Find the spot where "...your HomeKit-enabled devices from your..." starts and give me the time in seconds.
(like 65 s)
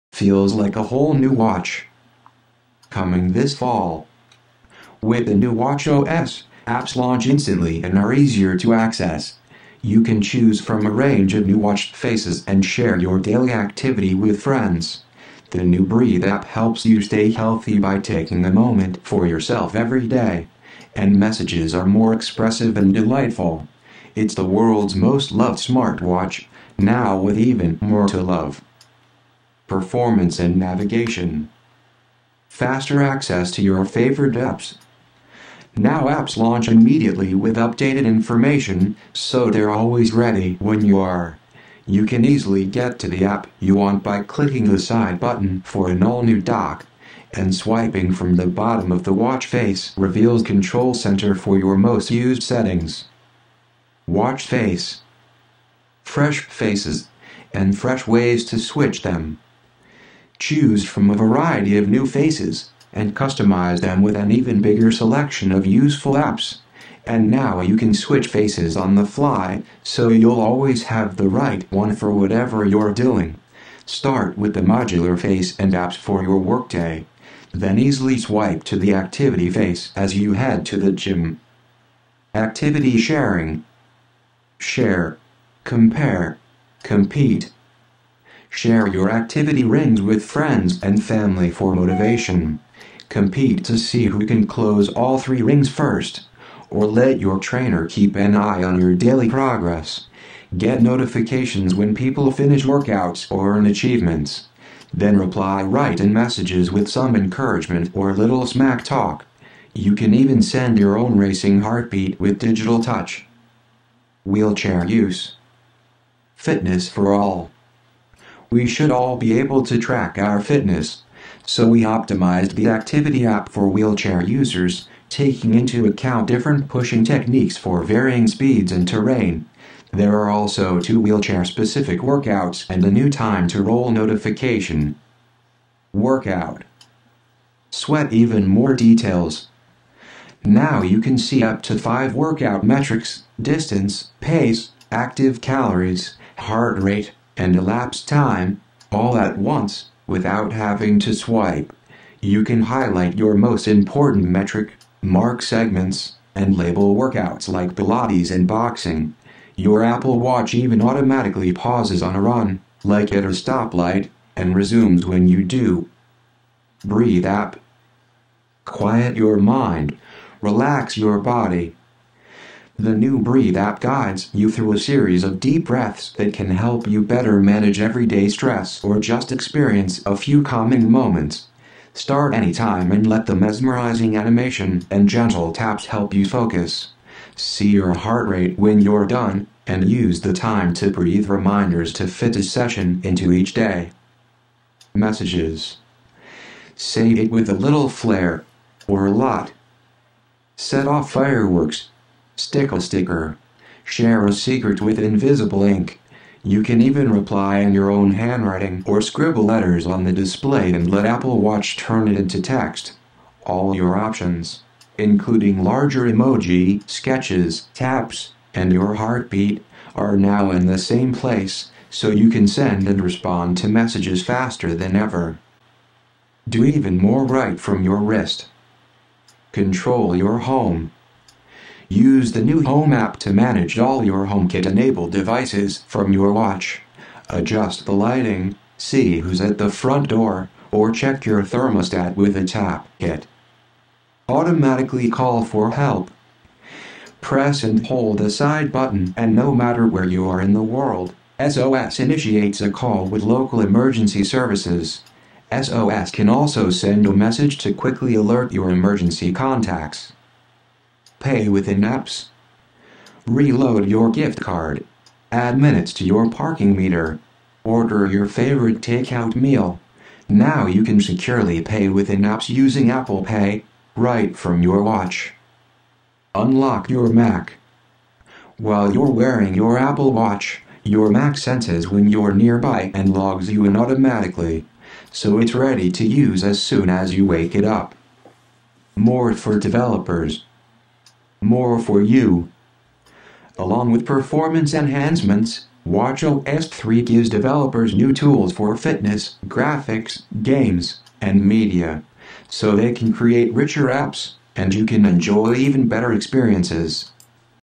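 234 s.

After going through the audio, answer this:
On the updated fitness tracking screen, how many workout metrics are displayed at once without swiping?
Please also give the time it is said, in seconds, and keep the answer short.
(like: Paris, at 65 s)
5, at 141 s.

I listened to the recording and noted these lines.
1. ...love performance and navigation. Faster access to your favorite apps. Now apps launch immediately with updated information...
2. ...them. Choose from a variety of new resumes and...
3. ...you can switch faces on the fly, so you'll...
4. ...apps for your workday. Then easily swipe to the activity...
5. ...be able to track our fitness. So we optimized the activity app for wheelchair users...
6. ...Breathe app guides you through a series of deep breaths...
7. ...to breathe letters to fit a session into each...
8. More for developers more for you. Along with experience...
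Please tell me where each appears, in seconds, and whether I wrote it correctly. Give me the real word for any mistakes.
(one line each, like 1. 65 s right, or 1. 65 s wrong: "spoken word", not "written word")
1. 28 s right
2. 59 s wrong: "faces", not "resumes"
3. 67 s right
4. 75 s right
5. 119 s right
6. 173 s right
7. 190 s wrong: "reminders", not "letters"
8. 288 s wrong: "performance", not "experience".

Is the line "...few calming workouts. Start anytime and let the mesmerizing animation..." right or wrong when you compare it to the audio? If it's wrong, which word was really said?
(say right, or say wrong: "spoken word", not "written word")
wrong: "moments", not "workouts".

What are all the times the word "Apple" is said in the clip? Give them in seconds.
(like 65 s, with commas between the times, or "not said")
159 s, 211 s, 272 s, 279 s.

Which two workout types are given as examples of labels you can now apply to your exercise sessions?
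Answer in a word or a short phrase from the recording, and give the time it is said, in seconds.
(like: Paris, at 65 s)
Pilates and boxing, at 157 s.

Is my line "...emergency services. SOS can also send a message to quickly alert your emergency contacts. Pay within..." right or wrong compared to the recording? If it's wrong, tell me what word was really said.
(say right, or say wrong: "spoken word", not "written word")
right.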